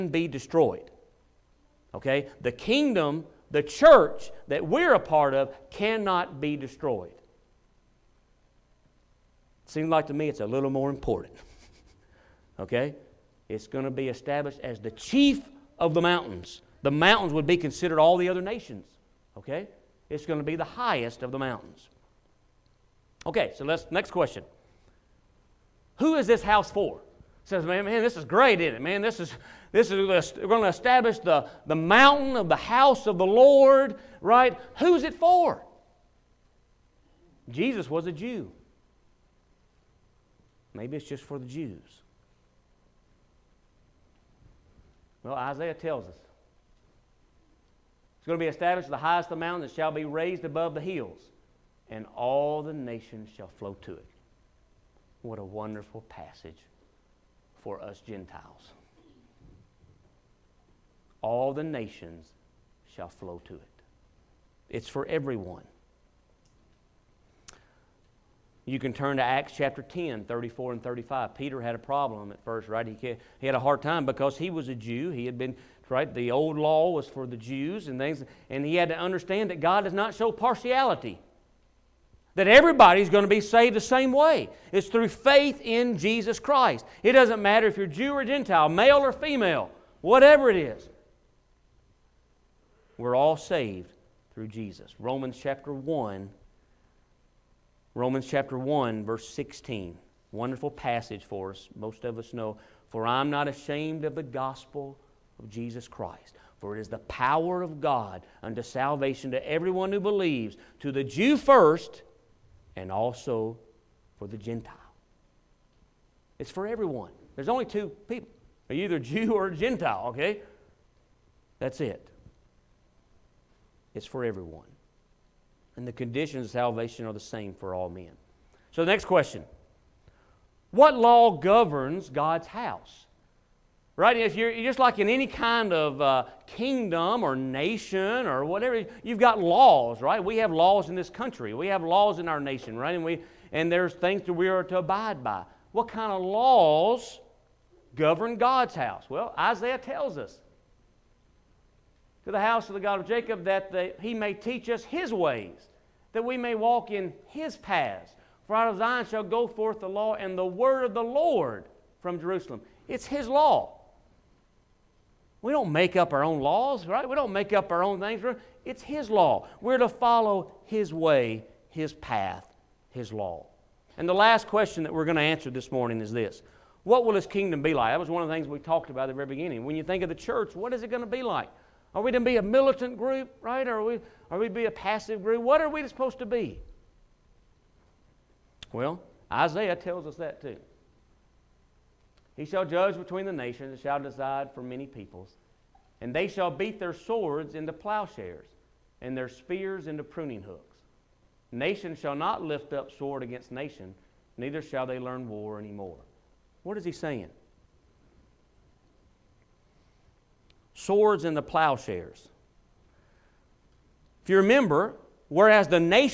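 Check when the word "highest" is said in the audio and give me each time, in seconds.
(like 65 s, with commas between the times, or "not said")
20 s, 48 s.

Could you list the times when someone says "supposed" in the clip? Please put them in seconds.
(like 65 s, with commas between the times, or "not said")
185 s.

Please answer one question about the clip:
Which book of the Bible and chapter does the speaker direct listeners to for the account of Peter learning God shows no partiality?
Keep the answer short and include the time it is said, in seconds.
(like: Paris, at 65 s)
Acts 10, at 69 s.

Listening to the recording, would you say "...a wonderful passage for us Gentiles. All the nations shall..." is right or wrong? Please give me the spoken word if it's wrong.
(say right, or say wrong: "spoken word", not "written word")
right.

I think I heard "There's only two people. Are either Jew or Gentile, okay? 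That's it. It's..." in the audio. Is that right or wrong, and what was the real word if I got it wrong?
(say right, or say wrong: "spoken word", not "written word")
right.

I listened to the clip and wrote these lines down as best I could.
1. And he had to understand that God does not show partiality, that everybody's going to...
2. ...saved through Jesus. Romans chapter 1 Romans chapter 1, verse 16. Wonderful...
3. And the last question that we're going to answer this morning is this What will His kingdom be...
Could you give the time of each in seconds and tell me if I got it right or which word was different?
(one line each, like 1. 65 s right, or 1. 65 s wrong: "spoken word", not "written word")
1. 78 s right
2. 93 s right
3. 173 s right.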